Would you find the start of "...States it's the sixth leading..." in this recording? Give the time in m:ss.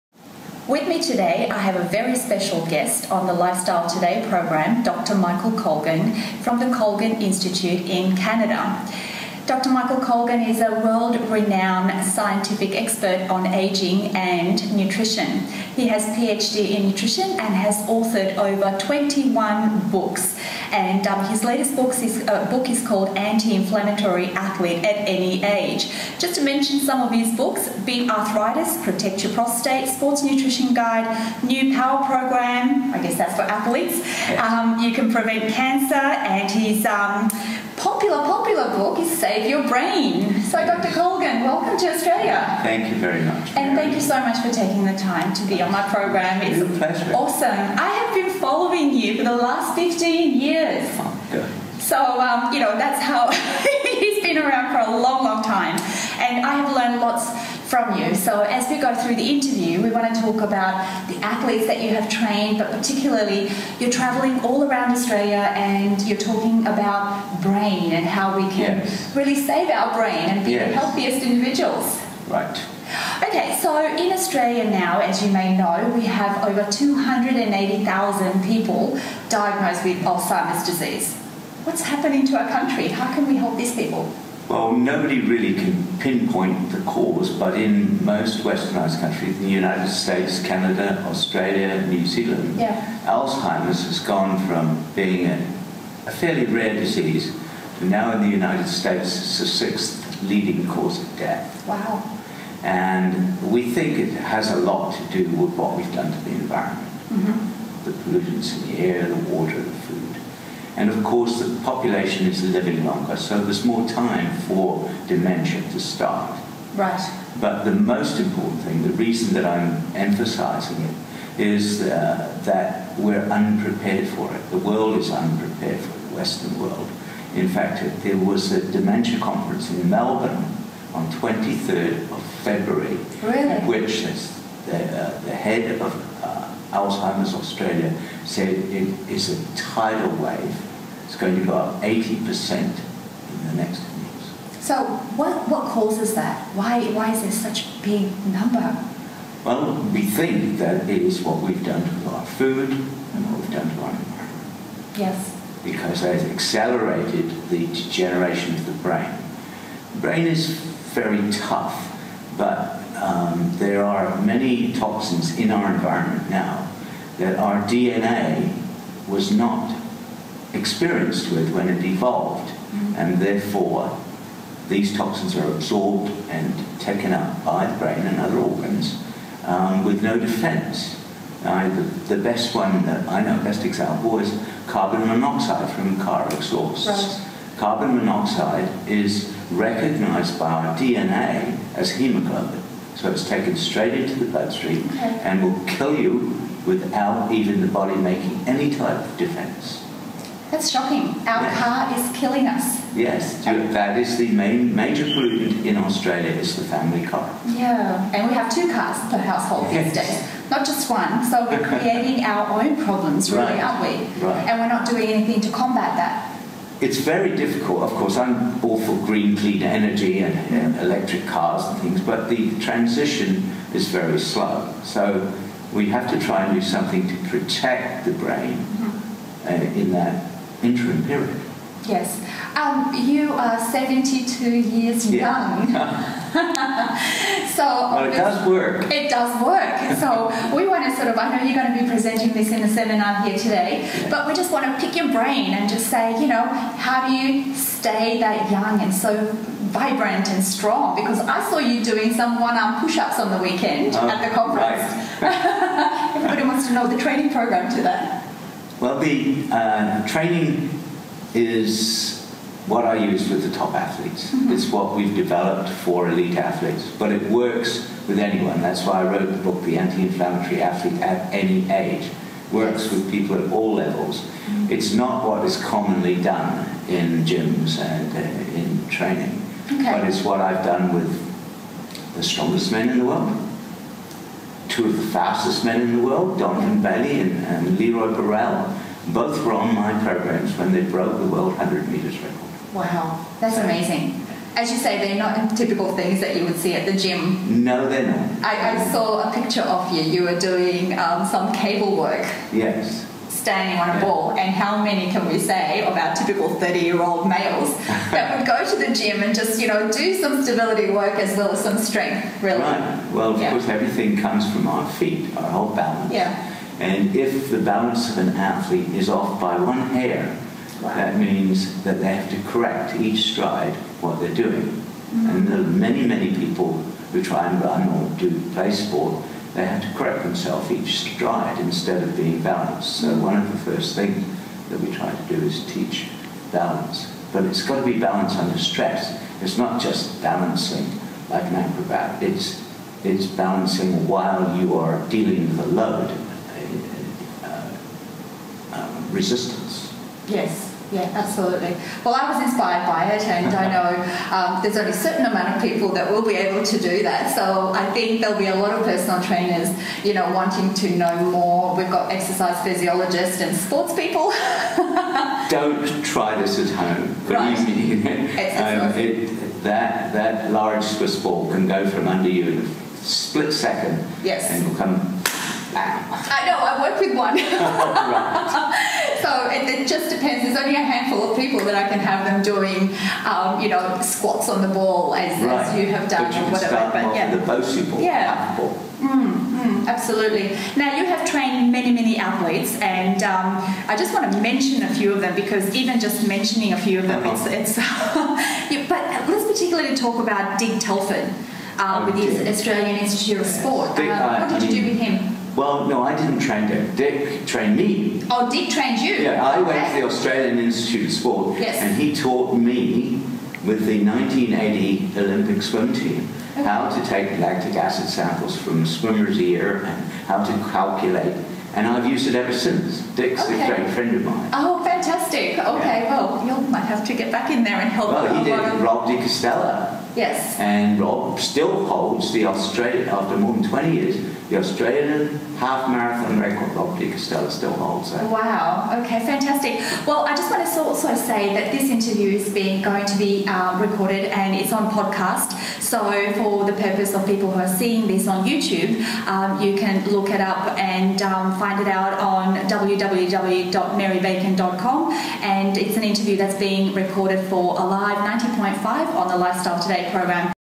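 1:38.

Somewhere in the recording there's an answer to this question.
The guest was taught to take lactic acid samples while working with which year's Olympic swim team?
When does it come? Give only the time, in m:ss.
6:54.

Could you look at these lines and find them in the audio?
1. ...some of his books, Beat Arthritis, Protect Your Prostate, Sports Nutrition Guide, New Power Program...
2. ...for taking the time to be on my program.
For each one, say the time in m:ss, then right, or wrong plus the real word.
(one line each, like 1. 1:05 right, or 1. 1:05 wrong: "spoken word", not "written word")
1. 0:26 right
2. 0:44 right.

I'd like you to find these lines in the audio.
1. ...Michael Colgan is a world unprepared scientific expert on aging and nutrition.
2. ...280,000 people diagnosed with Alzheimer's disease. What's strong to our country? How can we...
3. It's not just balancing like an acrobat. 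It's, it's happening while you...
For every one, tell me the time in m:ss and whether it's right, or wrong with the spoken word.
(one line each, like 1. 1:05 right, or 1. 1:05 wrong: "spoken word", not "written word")
1. 0:09 wrong: "renowned", not "unprepared"
2. 1:16 wrong: "happening", not "strong"
3. 5:39 wrong: "balancing", not "happening".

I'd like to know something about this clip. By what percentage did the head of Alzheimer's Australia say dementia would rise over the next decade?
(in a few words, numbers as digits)
80%.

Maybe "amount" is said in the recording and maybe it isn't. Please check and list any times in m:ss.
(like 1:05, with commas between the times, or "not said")
5:55.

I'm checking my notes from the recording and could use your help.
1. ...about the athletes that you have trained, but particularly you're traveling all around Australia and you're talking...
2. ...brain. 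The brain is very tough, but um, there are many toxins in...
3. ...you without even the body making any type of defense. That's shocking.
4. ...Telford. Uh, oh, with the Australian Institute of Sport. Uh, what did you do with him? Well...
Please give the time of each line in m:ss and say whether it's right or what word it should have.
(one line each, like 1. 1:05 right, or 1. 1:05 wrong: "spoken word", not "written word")
1. 1:00 right
2. 2:38 right
3. 3:15 right
4. 6:40 right.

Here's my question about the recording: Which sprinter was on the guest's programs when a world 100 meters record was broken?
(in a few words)
Donovan Bailey.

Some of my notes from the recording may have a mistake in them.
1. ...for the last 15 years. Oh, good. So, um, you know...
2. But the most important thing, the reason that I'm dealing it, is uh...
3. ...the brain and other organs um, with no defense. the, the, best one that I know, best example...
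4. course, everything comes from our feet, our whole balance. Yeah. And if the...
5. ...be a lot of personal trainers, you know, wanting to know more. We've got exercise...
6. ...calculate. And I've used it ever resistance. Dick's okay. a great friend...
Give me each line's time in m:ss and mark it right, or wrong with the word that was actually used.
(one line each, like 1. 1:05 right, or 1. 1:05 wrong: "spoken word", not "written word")
1. 0:49 right
2. 1:57 wrong: "emphasizing", not "dealing"
3. 2:57 right
4. 5:13 right
5. 5:58 right
6. 7:00 wrong: "since", not "resistance".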